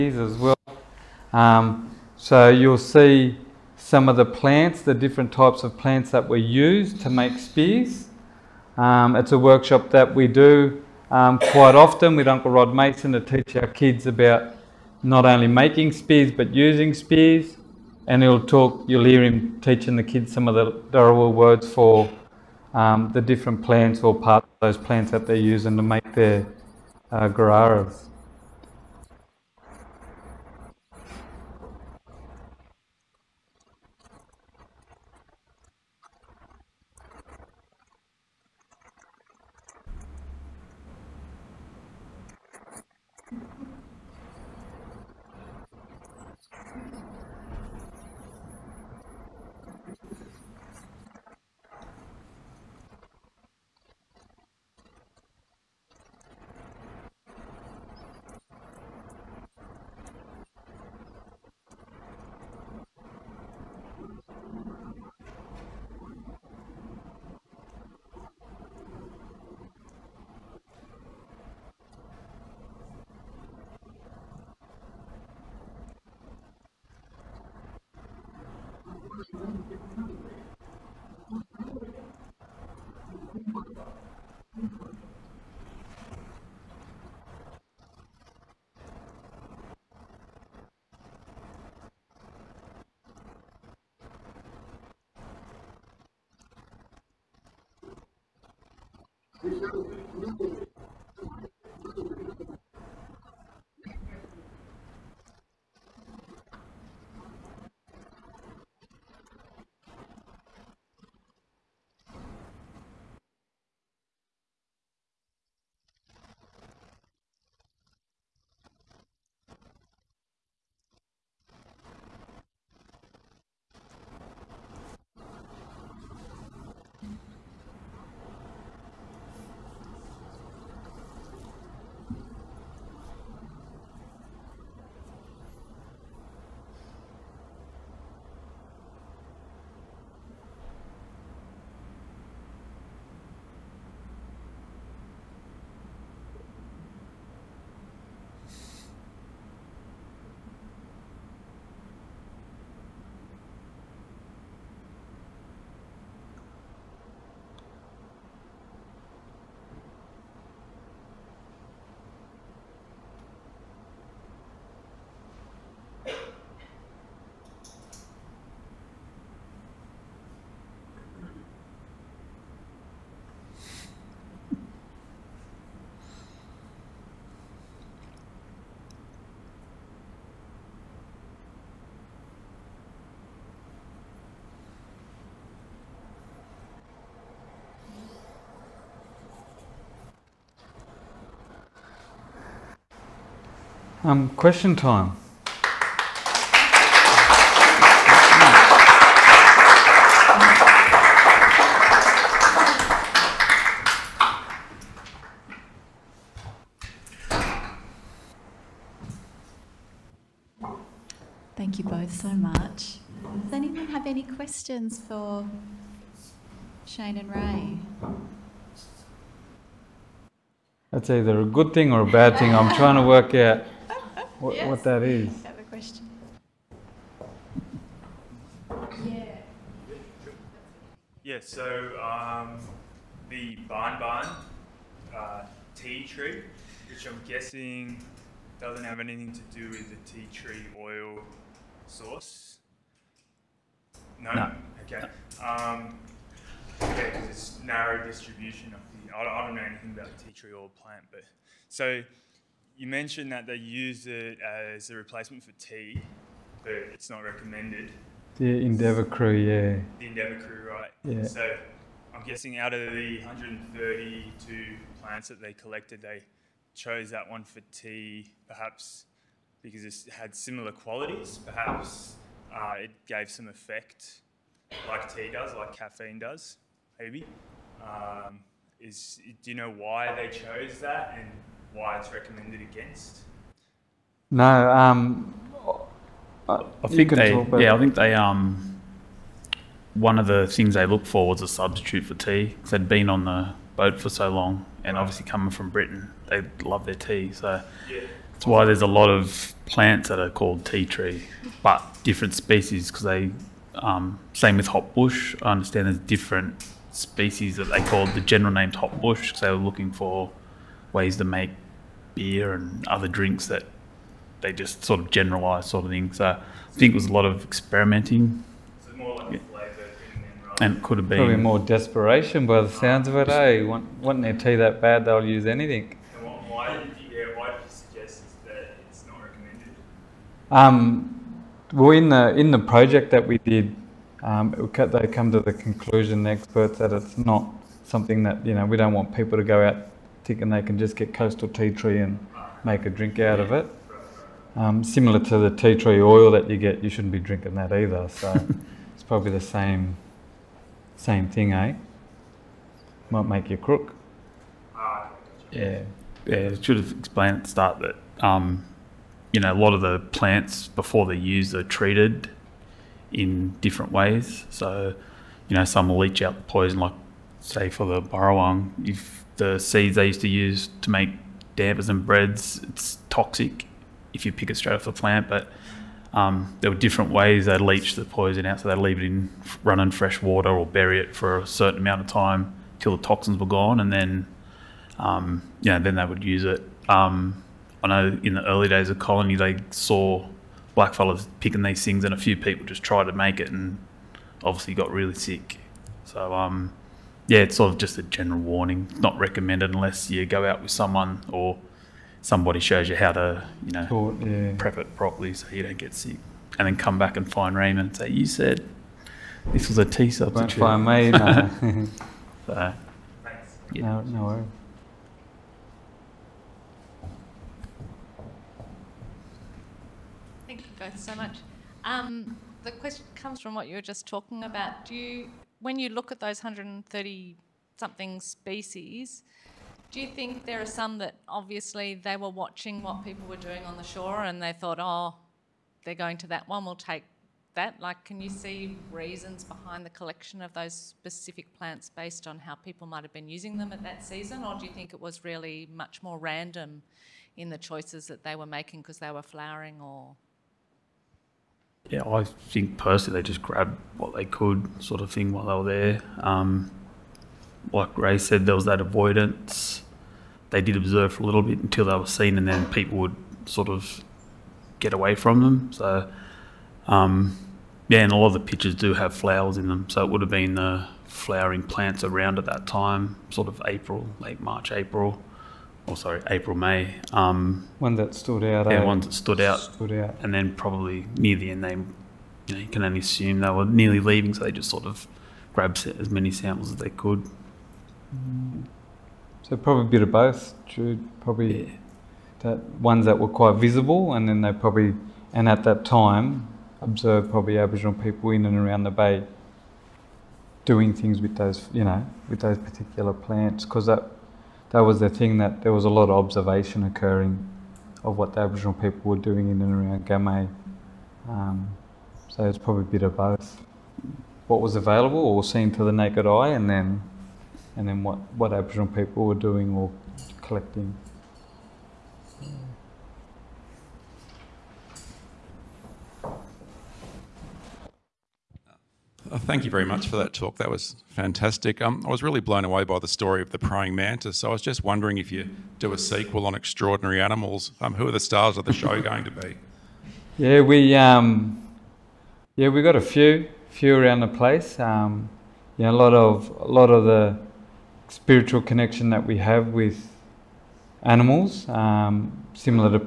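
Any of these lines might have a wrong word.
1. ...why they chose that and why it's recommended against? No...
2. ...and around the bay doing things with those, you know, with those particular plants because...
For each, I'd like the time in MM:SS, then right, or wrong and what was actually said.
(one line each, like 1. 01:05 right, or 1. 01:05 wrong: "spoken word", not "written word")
1. 04:39 right
2. 08:18 right.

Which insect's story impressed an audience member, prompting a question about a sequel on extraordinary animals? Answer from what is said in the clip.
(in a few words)
praying mantis.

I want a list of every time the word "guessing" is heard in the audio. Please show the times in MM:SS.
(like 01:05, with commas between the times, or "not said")
03:57, 04:22.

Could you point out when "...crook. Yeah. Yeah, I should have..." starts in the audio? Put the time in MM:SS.
05:53.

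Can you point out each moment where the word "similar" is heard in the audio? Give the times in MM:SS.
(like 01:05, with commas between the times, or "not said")
04:30, 05:44, 09:12.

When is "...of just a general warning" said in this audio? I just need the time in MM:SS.
06:37.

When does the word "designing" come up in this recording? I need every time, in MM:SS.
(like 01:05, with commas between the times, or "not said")
not said.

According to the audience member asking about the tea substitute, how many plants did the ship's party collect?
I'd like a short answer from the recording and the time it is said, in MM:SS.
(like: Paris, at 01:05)
132, at 04:23.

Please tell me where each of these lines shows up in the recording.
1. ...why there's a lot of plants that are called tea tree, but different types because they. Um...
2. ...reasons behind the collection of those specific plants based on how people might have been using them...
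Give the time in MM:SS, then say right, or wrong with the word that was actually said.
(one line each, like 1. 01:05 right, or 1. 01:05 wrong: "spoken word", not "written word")
1. 04:58 wrong: "species", not "types"
2. 07:18 right.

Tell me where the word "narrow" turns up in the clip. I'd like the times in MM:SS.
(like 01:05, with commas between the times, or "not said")
04:07.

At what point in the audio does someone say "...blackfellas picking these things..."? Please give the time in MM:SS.
06:30.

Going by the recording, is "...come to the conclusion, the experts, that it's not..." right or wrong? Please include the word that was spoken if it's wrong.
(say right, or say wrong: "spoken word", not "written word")
right.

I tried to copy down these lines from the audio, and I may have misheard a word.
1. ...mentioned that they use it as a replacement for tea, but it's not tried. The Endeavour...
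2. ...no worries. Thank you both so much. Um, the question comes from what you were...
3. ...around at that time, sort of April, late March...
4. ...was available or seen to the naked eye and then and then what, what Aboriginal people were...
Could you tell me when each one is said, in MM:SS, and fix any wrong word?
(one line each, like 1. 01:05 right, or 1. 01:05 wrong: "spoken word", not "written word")
1. 04:12 wrong: "recommended", not "tried"
2. 06:54 right
3. 07:52 right
4. 08:34 right.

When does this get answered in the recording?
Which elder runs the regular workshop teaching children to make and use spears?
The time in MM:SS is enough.
00:12.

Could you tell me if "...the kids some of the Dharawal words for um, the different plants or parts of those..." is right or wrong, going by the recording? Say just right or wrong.
right.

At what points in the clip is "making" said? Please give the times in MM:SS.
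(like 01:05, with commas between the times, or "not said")
00:15, 07:28.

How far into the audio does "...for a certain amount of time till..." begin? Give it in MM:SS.
06:21.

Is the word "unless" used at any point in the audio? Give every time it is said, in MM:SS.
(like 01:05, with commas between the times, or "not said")
06:39.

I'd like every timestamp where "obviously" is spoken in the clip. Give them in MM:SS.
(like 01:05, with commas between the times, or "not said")
04:55, 06:34, 07:11.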